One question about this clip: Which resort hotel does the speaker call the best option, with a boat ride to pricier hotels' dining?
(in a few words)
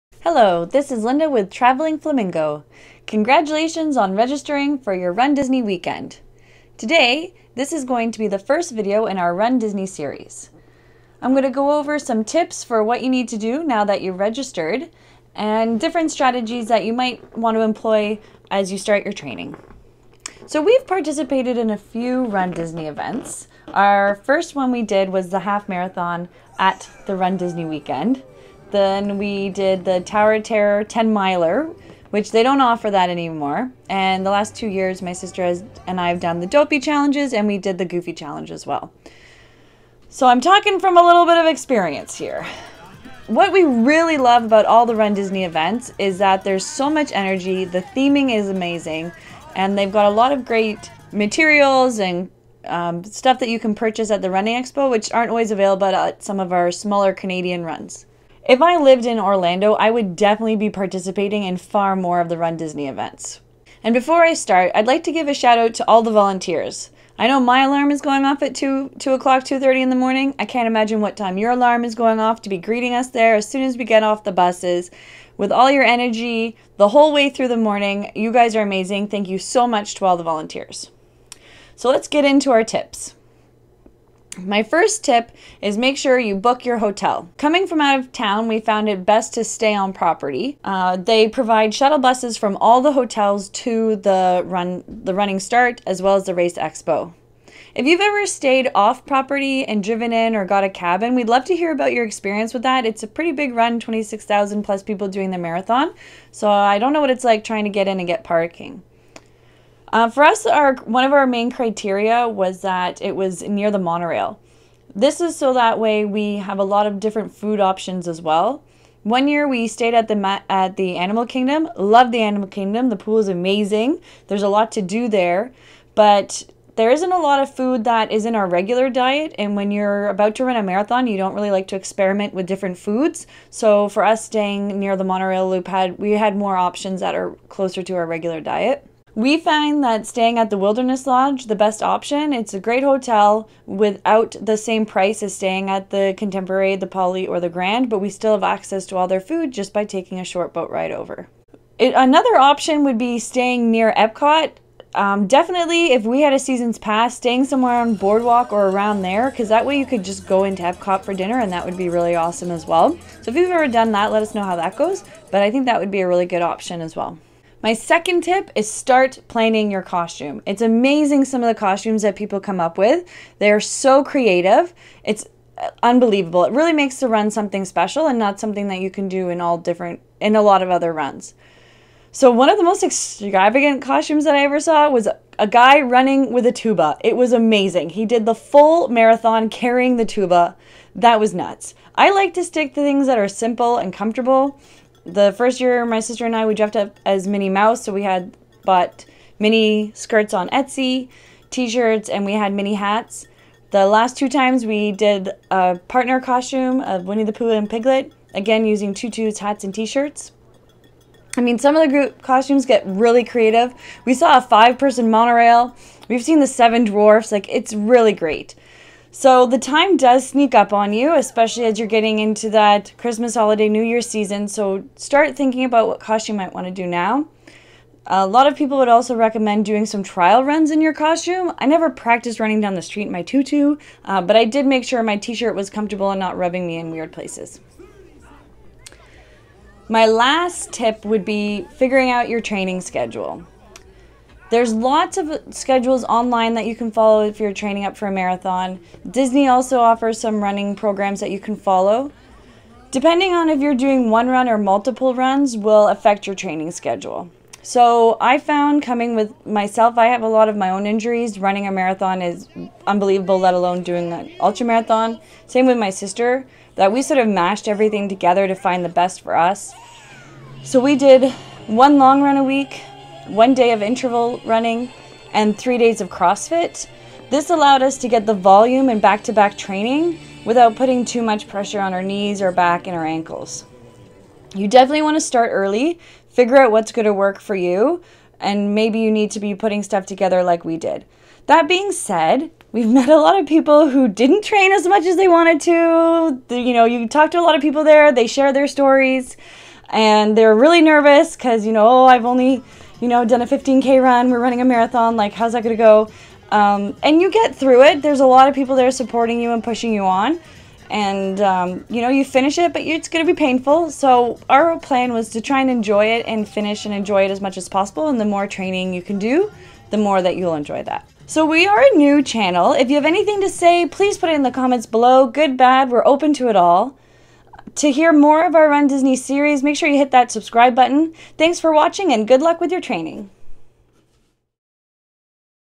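Wilderness Lodge.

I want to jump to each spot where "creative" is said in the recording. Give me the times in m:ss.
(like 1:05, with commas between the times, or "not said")
2:54, 3:33.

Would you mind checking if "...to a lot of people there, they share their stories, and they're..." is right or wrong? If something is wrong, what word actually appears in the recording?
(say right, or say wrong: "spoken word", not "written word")
right.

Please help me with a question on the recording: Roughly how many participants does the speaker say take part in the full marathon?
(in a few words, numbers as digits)
26,000.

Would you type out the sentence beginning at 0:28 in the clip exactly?
Then we did the Tower Terror 10 miler, which they don't offer that anymore.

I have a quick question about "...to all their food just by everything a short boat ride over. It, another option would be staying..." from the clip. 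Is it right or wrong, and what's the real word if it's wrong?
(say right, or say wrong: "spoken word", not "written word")
wrong: "taking", not "everything".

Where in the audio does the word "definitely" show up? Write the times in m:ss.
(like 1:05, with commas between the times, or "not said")
1:00, 2:35, 4:44.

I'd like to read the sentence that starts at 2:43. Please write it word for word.
So if you've ever done that, let us know how that goes.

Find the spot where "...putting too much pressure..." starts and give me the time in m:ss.
4:40.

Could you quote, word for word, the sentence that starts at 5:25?
Good, bad, we're open to it all to hear more of our Run Disney series, make sure you hit that subscribe button.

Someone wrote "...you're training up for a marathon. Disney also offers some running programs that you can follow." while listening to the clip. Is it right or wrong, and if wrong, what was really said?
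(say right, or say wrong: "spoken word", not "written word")
right.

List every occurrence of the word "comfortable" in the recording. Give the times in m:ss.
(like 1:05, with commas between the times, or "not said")
3:13, 3:55.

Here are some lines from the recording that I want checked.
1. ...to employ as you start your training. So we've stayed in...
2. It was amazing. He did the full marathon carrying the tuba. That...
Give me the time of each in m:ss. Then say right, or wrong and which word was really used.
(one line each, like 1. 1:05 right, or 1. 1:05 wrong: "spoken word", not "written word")
1. 0:17 wrong: "participated", not "stayed"
2. 3:07 right.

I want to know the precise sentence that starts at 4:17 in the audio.
So I found coming with myself, I have a lot of my own injuries.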